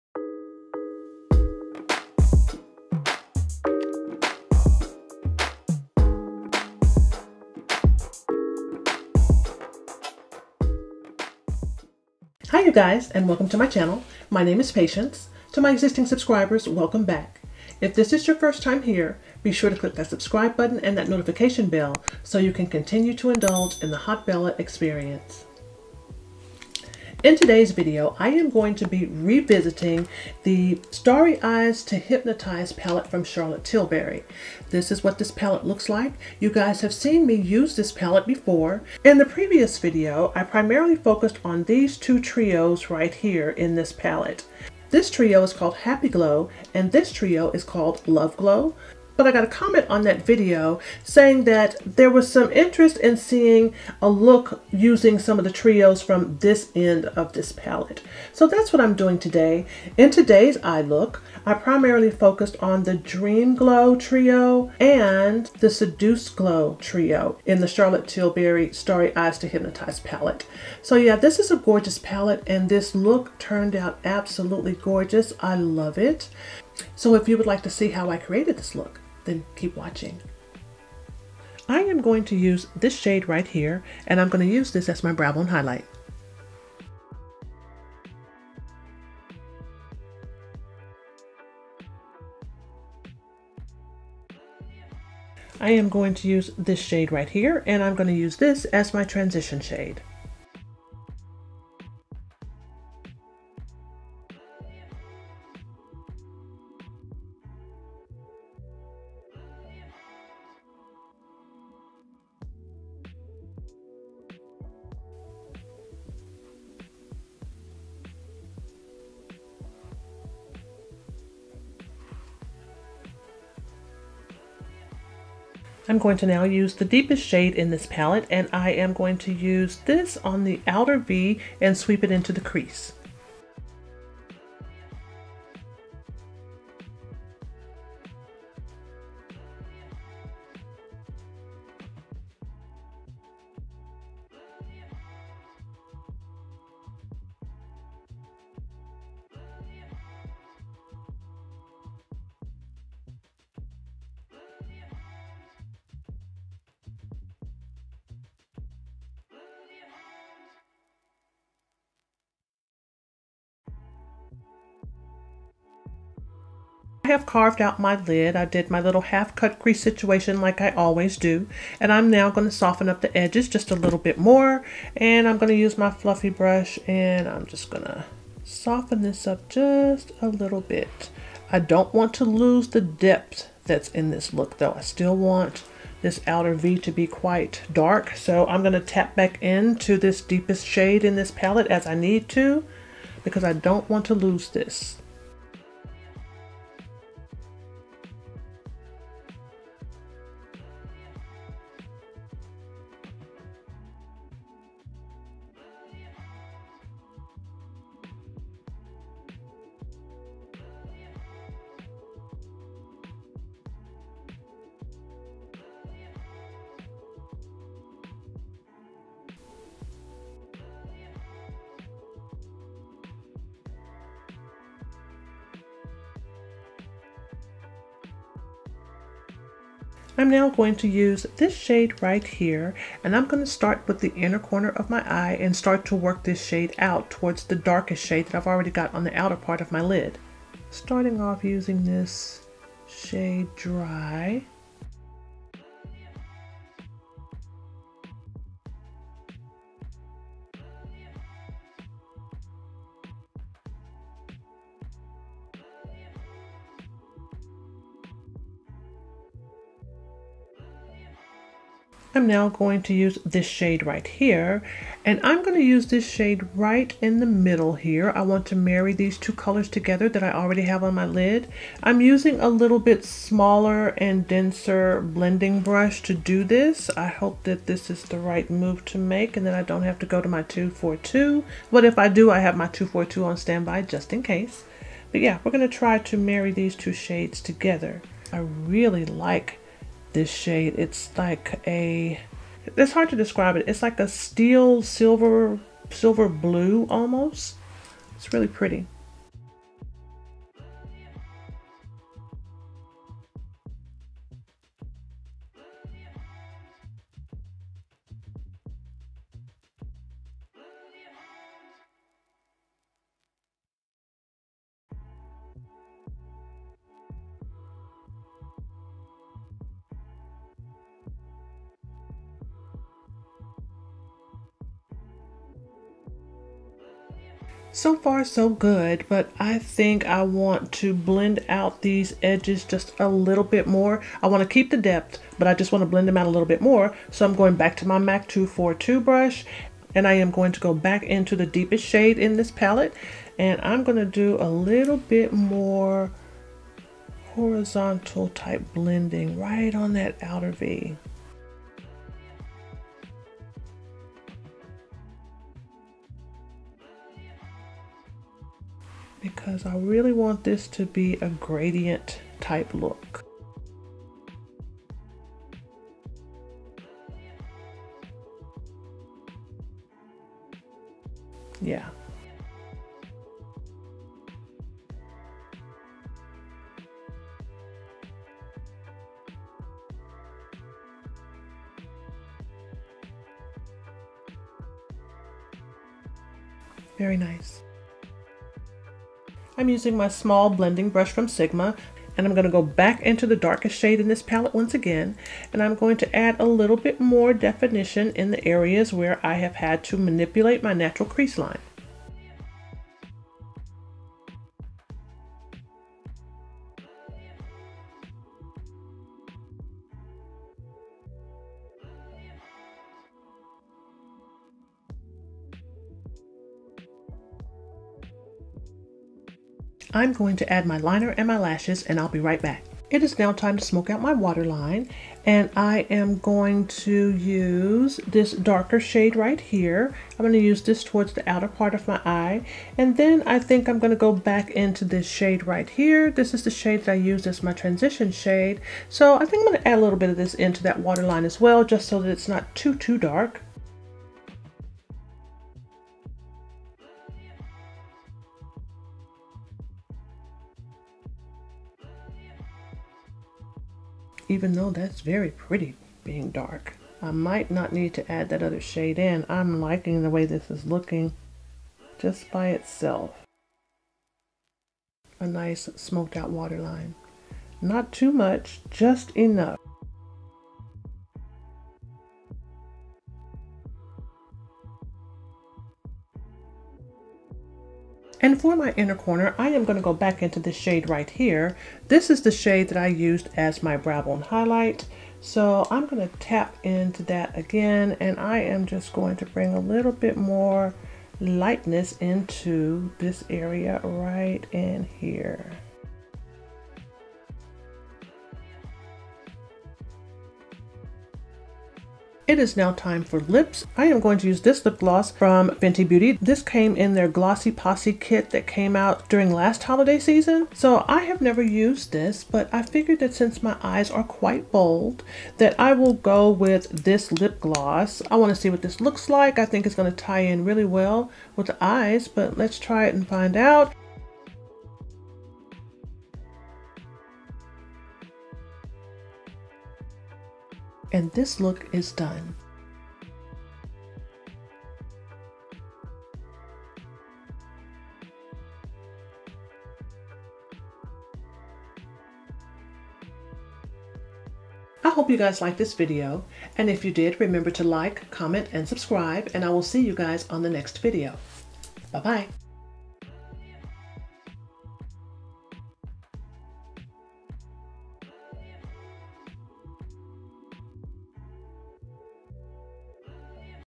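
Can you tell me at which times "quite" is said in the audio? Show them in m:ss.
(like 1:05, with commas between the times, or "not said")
3:07, 8:34.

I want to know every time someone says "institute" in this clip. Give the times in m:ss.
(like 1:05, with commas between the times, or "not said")
not said.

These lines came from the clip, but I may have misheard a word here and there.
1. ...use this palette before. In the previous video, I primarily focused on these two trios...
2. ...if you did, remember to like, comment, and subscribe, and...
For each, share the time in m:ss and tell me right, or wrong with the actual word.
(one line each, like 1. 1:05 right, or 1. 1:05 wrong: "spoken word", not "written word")
1. 0:37 right
2. 9:06 right.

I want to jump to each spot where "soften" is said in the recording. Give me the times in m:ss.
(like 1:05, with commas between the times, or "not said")
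2:52, 2:58.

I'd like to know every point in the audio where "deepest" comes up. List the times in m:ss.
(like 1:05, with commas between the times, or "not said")
2:06, 3:10, 5:41.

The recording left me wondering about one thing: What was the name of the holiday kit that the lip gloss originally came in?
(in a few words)
Glossy Posse.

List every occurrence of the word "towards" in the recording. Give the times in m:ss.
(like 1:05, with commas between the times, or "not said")
3:57, 7:10.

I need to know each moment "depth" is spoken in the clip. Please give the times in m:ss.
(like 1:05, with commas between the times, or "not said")
3:02, 5:34.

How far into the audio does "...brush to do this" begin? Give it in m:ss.
4:35.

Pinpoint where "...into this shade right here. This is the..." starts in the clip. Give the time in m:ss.
7:14.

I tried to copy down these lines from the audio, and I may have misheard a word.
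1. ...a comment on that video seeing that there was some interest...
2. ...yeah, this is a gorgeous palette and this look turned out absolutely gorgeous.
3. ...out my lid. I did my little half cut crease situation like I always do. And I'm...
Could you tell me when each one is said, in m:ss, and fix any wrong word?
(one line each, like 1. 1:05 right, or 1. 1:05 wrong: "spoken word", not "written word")
1. 0:49 wrong: "saying", not "seeing"
2. 1:10 right
3. 2:47 right.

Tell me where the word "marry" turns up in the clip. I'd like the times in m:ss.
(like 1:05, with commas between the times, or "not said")
4:28, 4:46.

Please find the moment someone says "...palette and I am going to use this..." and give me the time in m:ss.
2:07.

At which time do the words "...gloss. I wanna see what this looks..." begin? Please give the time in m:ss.
8:37.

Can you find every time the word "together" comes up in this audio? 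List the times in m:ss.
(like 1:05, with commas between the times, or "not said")
4:29, 4:47.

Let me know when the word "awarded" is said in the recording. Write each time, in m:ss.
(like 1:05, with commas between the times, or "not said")
not said.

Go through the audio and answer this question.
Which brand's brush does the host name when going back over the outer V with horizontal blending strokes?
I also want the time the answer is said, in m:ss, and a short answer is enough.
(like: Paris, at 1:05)
MAC, at 5:37.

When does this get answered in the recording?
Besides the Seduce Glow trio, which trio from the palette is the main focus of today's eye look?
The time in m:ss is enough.
1:02.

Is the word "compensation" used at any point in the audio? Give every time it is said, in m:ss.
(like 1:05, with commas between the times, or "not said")
not said.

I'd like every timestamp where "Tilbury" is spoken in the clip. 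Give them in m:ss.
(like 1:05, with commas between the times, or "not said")
0:33, 1:08.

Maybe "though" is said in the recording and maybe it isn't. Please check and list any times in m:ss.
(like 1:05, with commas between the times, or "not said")
3:04, 7:34.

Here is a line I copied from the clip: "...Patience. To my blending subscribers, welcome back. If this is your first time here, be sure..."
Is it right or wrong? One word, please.
wrong.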